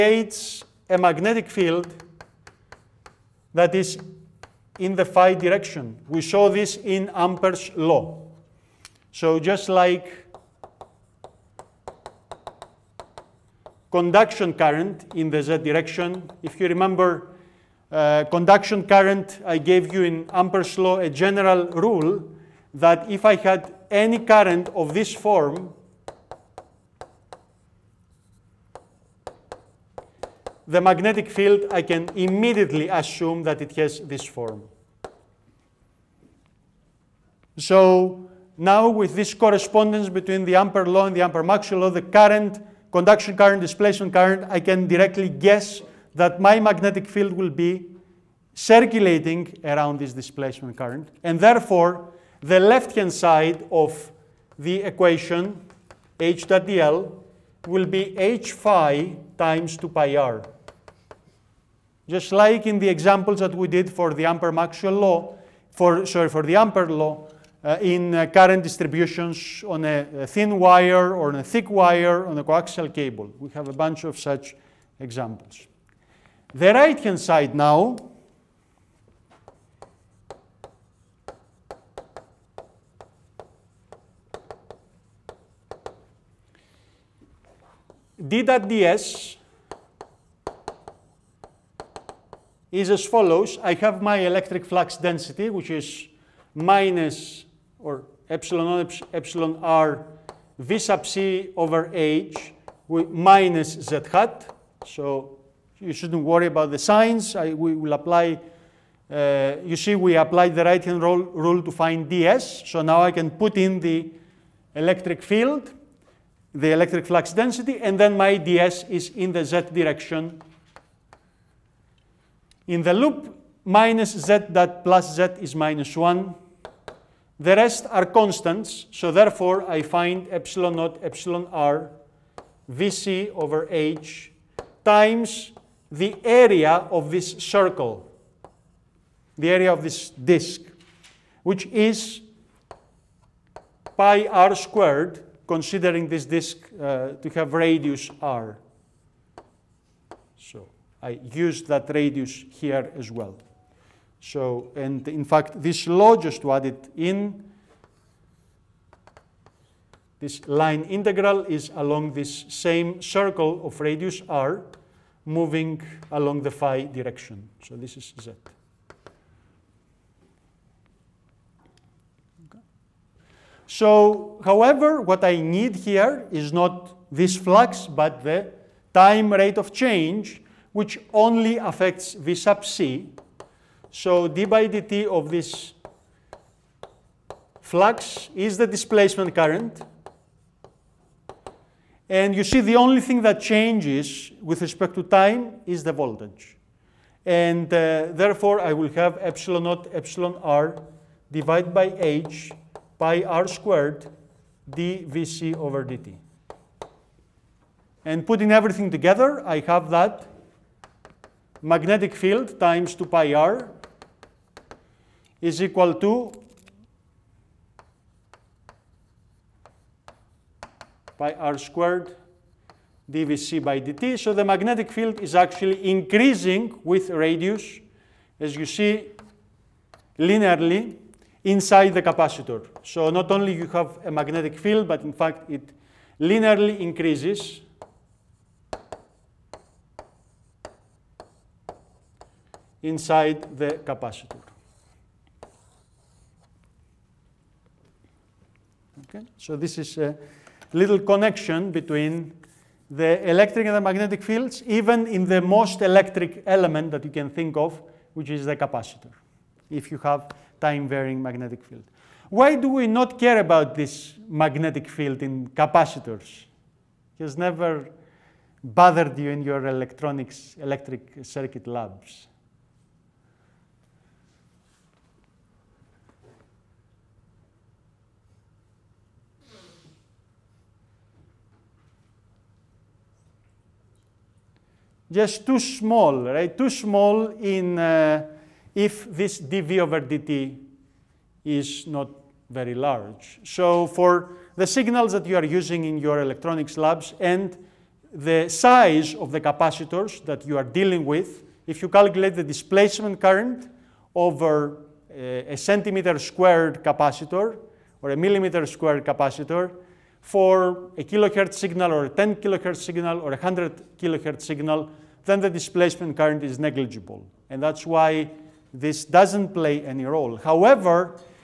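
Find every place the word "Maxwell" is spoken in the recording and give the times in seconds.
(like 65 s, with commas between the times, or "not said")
41 s, 64 s.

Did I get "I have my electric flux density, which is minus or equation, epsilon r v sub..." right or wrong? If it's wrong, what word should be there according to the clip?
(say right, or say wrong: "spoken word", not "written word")
wrong: "epsilon", not "equation".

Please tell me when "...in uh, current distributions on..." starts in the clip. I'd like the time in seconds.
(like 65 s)
67 s.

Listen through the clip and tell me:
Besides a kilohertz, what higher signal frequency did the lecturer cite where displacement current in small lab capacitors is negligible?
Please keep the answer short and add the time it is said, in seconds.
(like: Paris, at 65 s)
100 kilohertz, at 313 s.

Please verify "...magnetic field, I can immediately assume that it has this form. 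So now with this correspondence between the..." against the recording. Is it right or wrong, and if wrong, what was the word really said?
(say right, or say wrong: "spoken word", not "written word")
right.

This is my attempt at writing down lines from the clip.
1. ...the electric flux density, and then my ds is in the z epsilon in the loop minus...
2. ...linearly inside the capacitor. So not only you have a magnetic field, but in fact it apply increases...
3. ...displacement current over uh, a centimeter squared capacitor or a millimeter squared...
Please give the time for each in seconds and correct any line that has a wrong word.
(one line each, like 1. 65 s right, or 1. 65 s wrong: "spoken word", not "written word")
1. 116 s wrong: "direction", not "epsilon"
2. 230 s wrong: "linearly", not "apply"
3. 302 s right.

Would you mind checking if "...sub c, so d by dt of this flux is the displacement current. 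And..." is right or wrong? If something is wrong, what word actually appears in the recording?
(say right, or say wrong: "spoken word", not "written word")
right.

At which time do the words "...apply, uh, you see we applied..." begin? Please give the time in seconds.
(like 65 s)
107 s.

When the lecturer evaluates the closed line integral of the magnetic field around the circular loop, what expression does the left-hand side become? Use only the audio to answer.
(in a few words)
H phi times 2 pi r.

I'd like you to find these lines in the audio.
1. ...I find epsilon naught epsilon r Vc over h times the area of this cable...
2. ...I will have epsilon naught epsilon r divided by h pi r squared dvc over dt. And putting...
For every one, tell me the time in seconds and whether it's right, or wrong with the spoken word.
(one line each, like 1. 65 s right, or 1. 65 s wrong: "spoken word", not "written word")
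1. 129 s wrong: "circle", not "cable"
2. 198 s right.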